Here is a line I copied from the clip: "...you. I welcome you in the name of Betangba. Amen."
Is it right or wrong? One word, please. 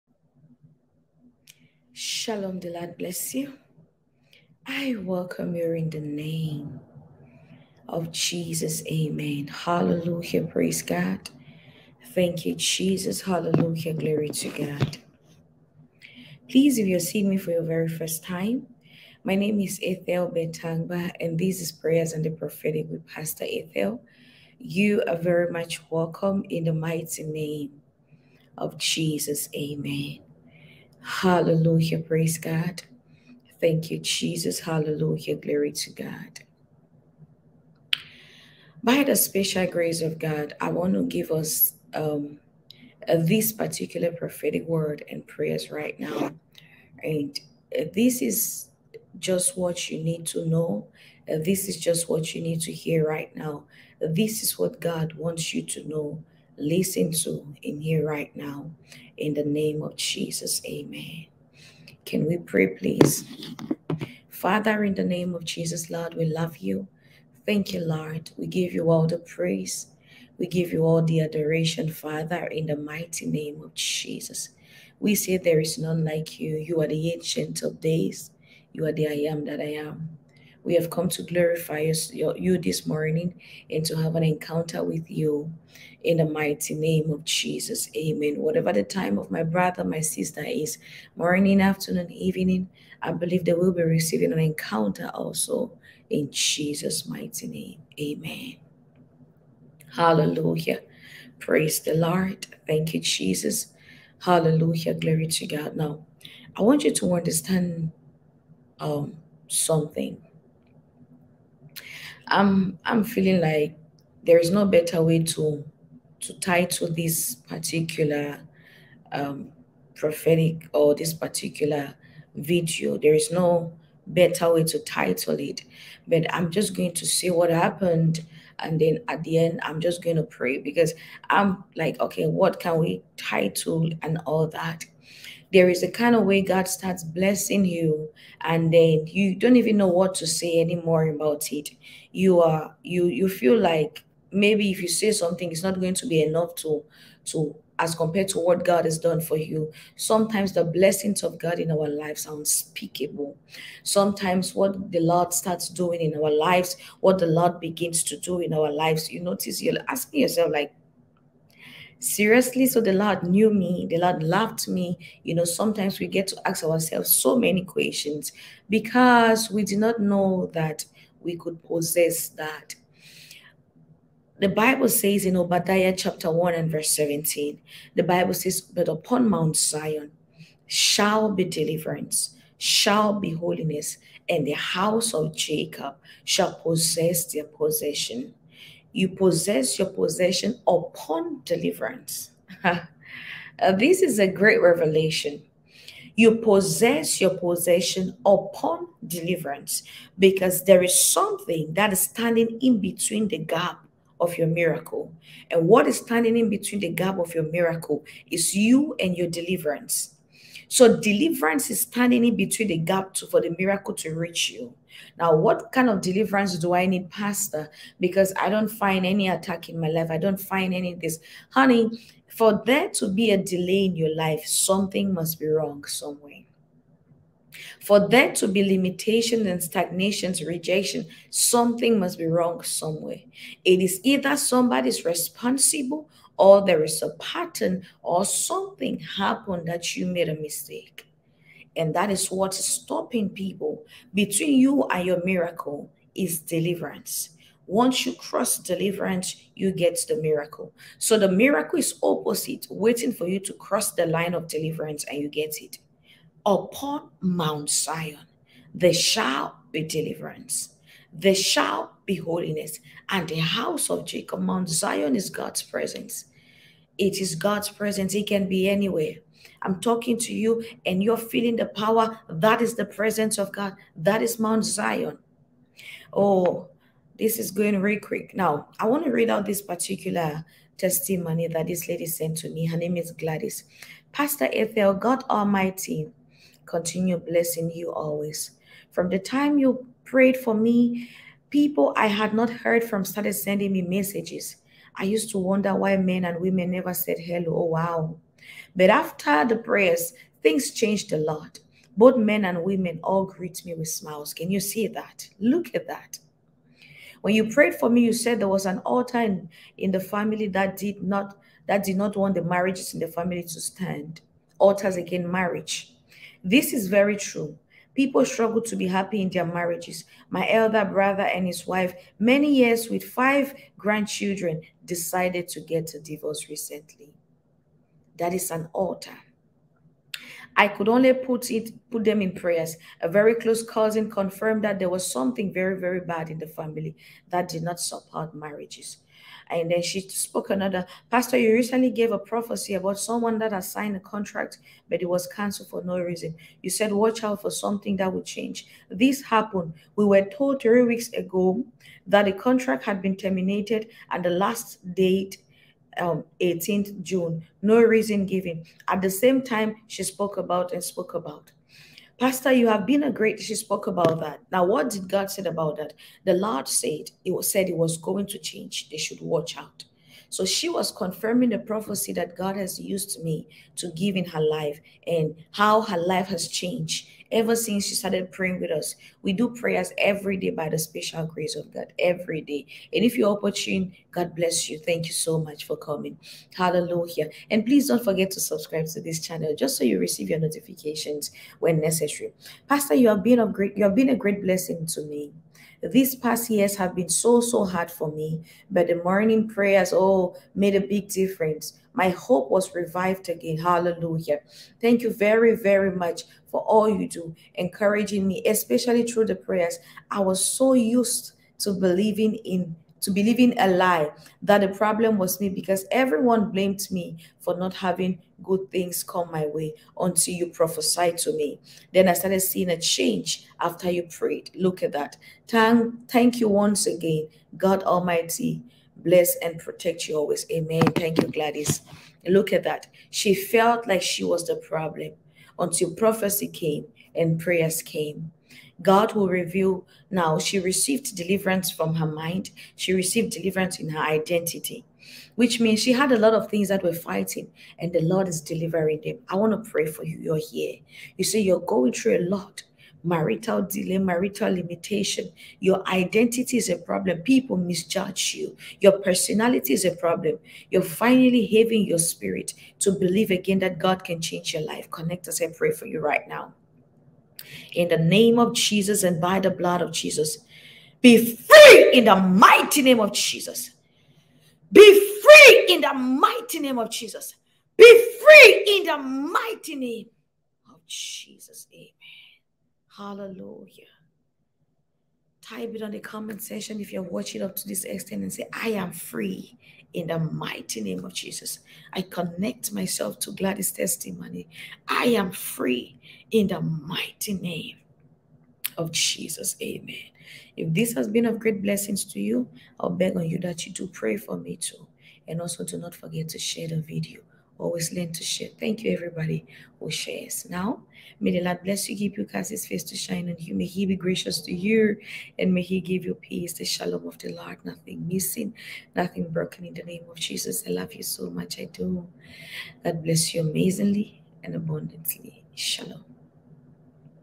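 wrong.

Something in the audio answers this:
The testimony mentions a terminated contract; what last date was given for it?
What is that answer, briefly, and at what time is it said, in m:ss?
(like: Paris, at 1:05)
18th June, at 5:56.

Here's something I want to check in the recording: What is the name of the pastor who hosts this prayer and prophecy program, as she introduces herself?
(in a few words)
Ethel Betangba.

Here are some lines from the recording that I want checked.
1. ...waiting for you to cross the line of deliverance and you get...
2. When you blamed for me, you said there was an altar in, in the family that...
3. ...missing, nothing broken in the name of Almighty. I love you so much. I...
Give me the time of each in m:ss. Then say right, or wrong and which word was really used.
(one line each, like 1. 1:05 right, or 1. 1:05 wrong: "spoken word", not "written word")
1. 4:12 right
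2. 5:07 wrong: "prayed", not "blamed"
3. 8:38 wrong: "Jesus", not "Almighty".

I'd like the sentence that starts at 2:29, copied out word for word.
Sometimes the blessings of God in our lives are unspeakable.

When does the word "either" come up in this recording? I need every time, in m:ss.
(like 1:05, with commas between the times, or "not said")
3:54.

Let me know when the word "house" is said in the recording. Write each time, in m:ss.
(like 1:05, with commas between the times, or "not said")
3:04, 4:23.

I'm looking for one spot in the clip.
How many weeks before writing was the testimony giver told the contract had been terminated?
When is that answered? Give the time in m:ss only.
5:50.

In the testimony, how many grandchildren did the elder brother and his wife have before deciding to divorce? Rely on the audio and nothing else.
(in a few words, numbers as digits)
5.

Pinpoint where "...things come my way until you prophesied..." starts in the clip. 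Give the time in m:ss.
6:58.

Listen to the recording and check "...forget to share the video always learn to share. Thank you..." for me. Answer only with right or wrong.
right.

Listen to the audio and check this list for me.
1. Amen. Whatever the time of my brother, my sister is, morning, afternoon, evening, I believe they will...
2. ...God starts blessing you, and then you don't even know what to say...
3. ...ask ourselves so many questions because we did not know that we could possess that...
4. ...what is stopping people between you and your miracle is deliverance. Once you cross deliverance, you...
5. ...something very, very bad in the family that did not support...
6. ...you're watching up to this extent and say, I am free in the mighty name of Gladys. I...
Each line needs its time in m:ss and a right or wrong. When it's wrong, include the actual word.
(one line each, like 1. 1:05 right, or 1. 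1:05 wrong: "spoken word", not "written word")
1. 1:27 right
2. 2:16 right
3. 2:46 right
4. 4:02 right
5. 5:35 right
6. 8:06 wrong: "Jesus", not "Gladys".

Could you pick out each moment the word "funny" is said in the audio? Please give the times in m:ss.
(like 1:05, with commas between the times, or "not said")
not said.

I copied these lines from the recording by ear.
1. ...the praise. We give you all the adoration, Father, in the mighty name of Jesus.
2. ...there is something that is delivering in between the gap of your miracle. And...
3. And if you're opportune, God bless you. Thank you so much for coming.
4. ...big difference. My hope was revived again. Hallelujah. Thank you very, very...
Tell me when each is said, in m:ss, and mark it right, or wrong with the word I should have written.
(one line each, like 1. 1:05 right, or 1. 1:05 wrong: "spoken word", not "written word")
1. 1:09 right
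2. 3:20 wrong: "standing", not "delivering"
3. 6:22 right
4. 6:40 right.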